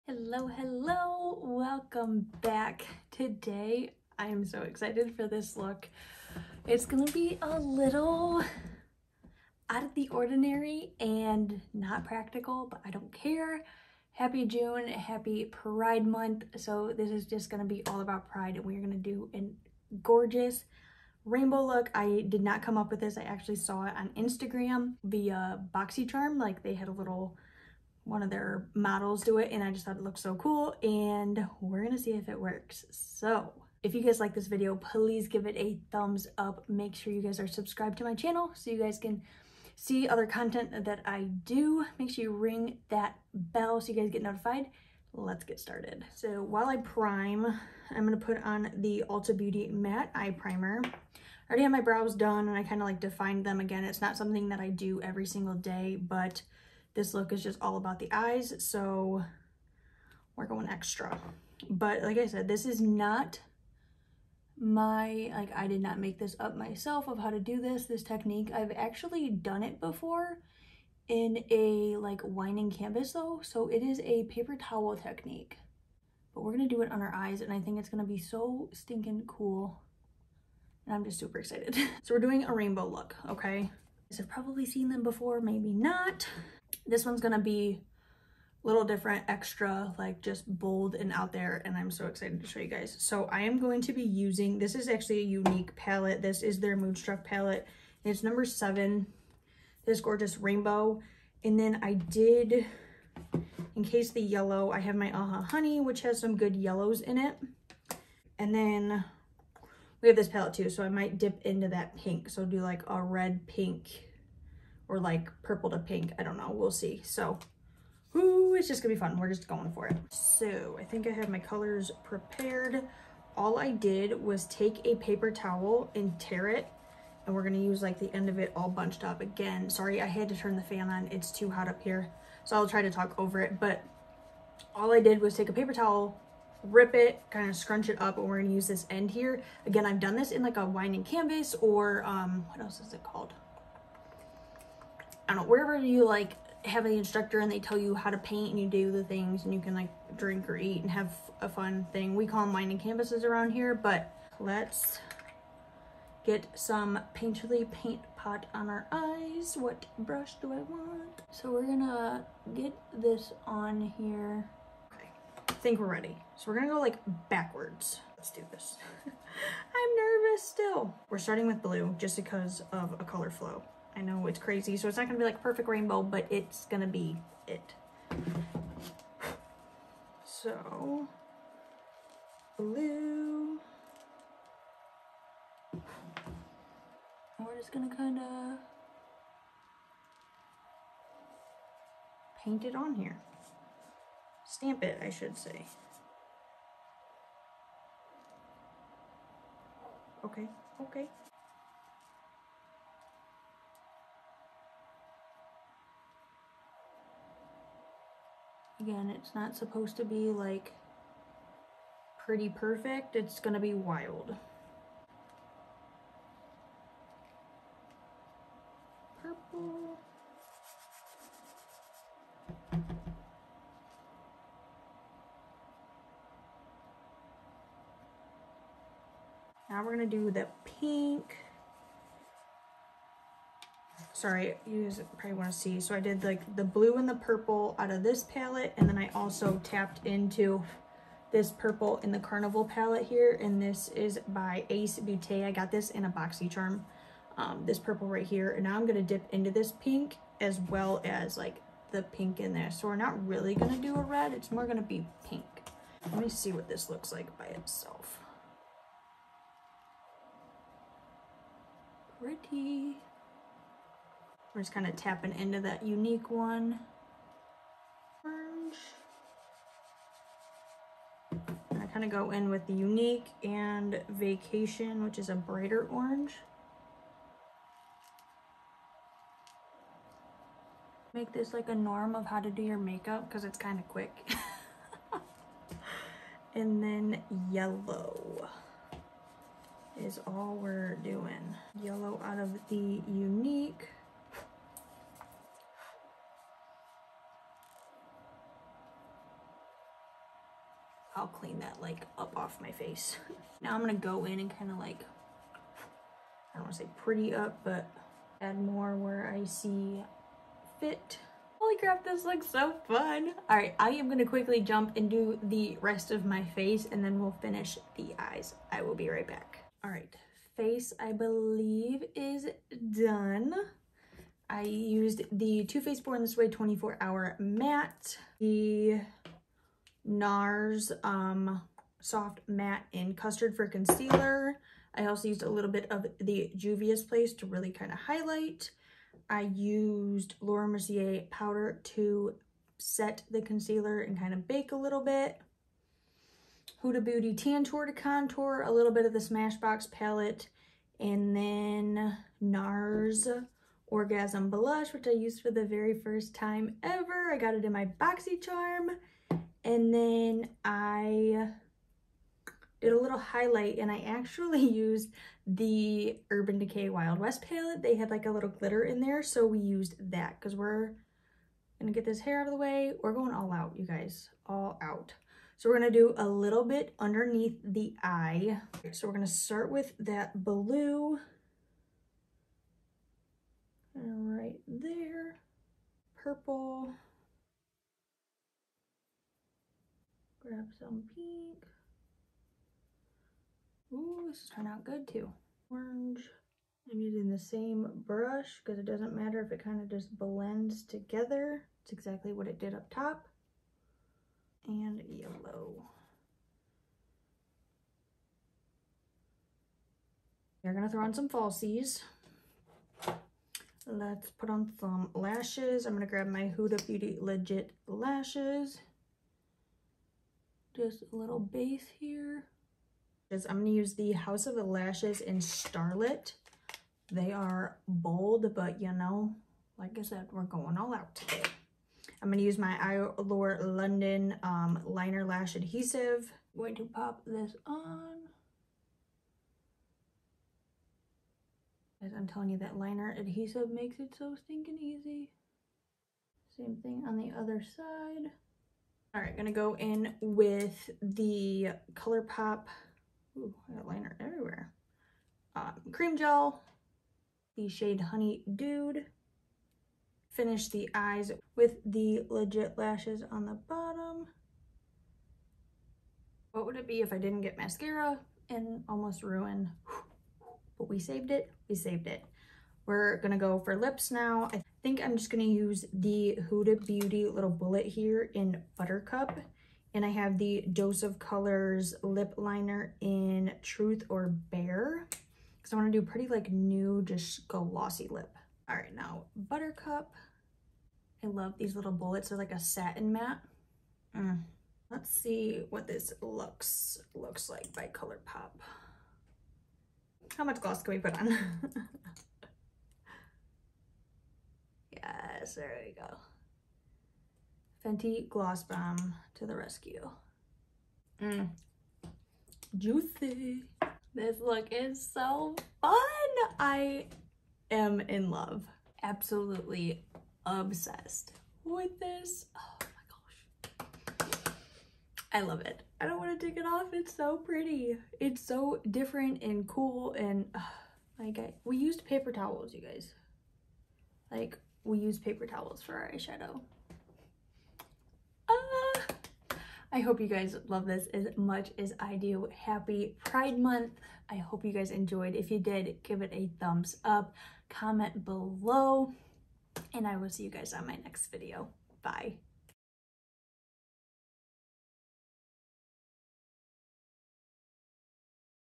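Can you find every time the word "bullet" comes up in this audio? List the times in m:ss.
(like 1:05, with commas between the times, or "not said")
7:57, 8:11.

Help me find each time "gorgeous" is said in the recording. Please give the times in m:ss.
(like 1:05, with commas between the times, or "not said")
0:20, 1:40.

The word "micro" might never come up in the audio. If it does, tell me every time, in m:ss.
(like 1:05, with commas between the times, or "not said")
not said.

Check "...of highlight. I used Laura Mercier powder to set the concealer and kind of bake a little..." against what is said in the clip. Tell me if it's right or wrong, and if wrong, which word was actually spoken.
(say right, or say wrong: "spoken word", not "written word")
right.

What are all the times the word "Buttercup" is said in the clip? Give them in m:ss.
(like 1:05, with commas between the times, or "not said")
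7:58, 8:09.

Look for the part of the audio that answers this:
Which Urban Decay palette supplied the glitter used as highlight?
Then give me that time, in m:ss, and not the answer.
6:06.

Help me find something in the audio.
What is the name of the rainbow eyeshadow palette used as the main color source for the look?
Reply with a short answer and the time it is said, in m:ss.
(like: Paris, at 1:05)
Moonstruck, at 1:36.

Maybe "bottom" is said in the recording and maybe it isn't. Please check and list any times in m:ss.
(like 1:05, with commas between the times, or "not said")
7:43.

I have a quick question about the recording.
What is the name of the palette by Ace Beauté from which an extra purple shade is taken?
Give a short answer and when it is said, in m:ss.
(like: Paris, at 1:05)
Carnival, at 4:02.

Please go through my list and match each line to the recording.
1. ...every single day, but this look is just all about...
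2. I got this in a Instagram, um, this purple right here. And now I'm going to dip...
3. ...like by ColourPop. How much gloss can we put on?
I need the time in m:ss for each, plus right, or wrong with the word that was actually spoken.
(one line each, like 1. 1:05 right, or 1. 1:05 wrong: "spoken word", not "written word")
1. 0:55 right
2. 4:05 wrong: "BoxyCharm", not "Instagram"
3. 8:17 right.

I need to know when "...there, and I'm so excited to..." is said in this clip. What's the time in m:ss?
1:31.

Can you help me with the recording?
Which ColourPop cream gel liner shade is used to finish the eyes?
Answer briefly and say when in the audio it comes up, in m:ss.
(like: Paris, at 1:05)
Honey Dude, at 7:37.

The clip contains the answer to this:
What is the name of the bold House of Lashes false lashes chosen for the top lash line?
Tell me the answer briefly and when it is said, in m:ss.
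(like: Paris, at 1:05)
Starlet, at 7:05.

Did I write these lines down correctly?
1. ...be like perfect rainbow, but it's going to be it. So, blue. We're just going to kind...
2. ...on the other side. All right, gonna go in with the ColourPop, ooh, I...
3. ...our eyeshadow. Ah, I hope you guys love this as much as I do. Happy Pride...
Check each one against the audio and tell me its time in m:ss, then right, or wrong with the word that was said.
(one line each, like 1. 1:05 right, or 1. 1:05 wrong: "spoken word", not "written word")
1. 2:55 right
2. 7:27 right
3. 8:55 right.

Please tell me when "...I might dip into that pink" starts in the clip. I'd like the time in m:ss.
1:50.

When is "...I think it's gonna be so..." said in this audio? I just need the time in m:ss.
1:17.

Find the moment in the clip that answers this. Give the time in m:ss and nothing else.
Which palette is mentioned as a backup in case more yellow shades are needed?
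1:45.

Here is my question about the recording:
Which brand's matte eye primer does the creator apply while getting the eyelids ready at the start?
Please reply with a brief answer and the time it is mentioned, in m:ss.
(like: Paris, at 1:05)
Ulta Beauty, at 0:49.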